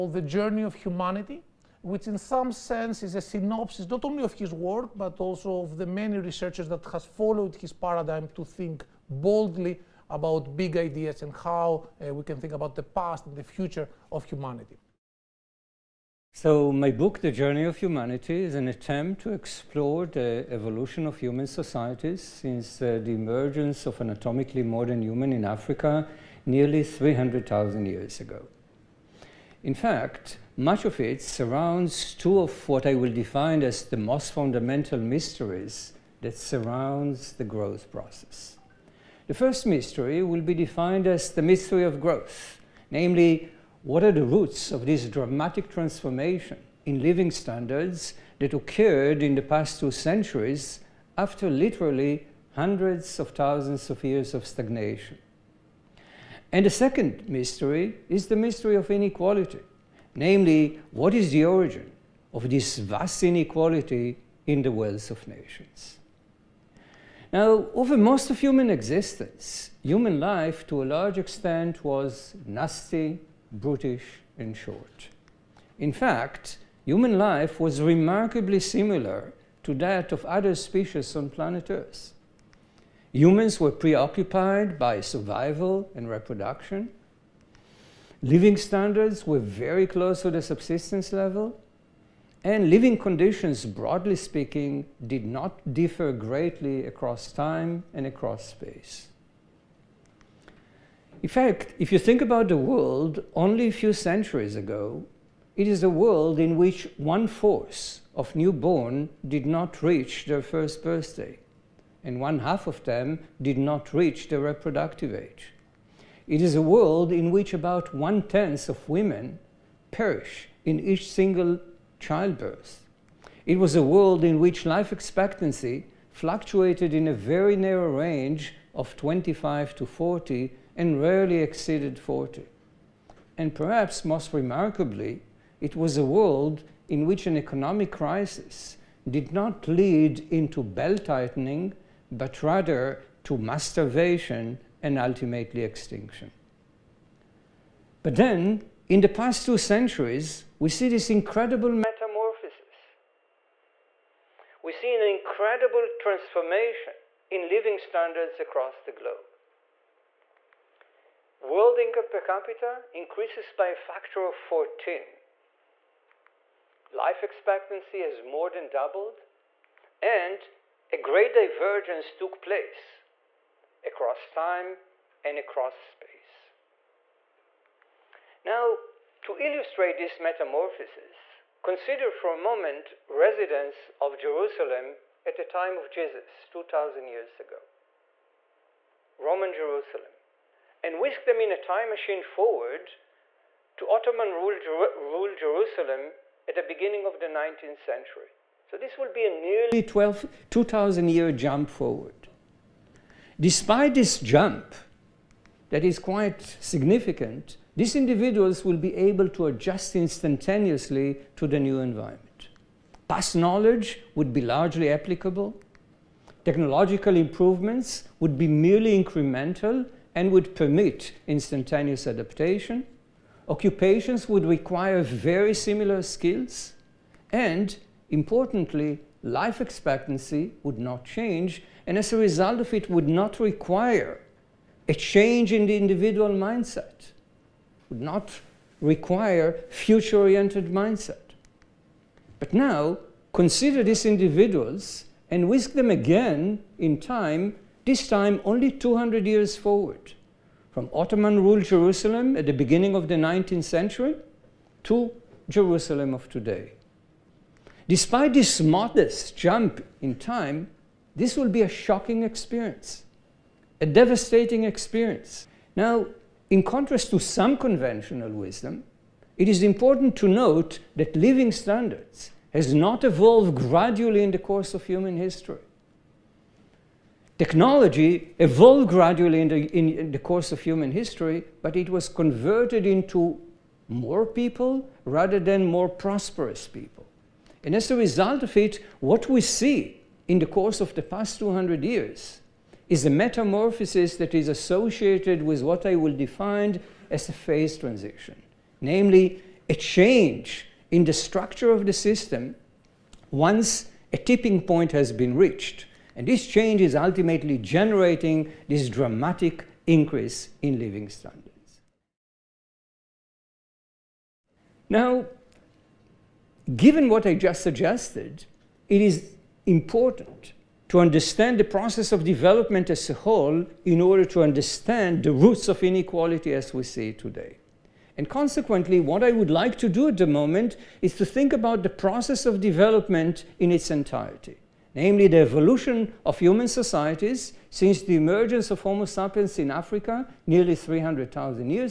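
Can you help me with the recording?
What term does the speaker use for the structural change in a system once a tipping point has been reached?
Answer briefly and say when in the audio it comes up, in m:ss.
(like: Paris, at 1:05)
Phase transition, at 4:57.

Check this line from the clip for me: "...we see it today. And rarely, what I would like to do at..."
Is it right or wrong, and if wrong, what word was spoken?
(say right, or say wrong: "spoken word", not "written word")
wrong: "consequently", not "rarely".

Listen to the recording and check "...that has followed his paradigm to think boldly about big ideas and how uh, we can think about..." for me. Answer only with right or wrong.
right.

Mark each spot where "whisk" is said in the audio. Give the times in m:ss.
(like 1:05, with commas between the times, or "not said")
3:11, 4:05.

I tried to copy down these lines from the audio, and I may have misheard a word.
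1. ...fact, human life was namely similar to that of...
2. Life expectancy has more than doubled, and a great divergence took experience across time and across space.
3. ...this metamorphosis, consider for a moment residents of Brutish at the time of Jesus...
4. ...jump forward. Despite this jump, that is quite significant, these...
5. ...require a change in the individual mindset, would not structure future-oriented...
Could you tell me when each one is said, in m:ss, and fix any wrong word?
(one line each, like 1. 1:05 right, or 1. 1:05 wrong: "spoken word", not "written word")
1. 1:15 wrong: "remarkably", not "namely"
2. 2:46 wrong: "place", not "experience"
3. 2:59 wrong: "Jerusalem", not "Brutish"
4. 3:21 right
5. 3:53 wrong: "require", not "structure".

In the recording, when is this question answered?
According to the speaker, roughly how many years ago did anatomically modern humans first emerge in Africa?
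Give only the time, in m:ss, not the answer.
0:26.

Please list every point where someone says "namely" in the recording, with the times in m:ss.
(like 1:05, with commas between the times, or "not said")
0:42, 1:00, 4:58, 5:34.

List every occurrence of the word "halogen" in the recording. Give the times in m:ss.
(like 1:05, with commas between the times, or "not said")
not said.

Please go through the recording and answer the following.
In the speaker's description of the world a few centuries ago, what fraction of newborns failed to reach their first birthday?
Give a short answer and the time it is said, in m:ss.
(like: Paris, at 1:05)
One fourth, at 1:46.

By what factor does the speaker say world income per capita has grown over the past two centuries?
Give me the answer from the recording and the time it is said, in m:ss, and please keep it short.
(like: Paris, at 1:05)
14, at 2:43.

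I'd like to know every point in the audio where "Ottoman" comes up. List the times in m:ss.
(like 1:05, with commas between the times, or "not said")
3:13, 4:10.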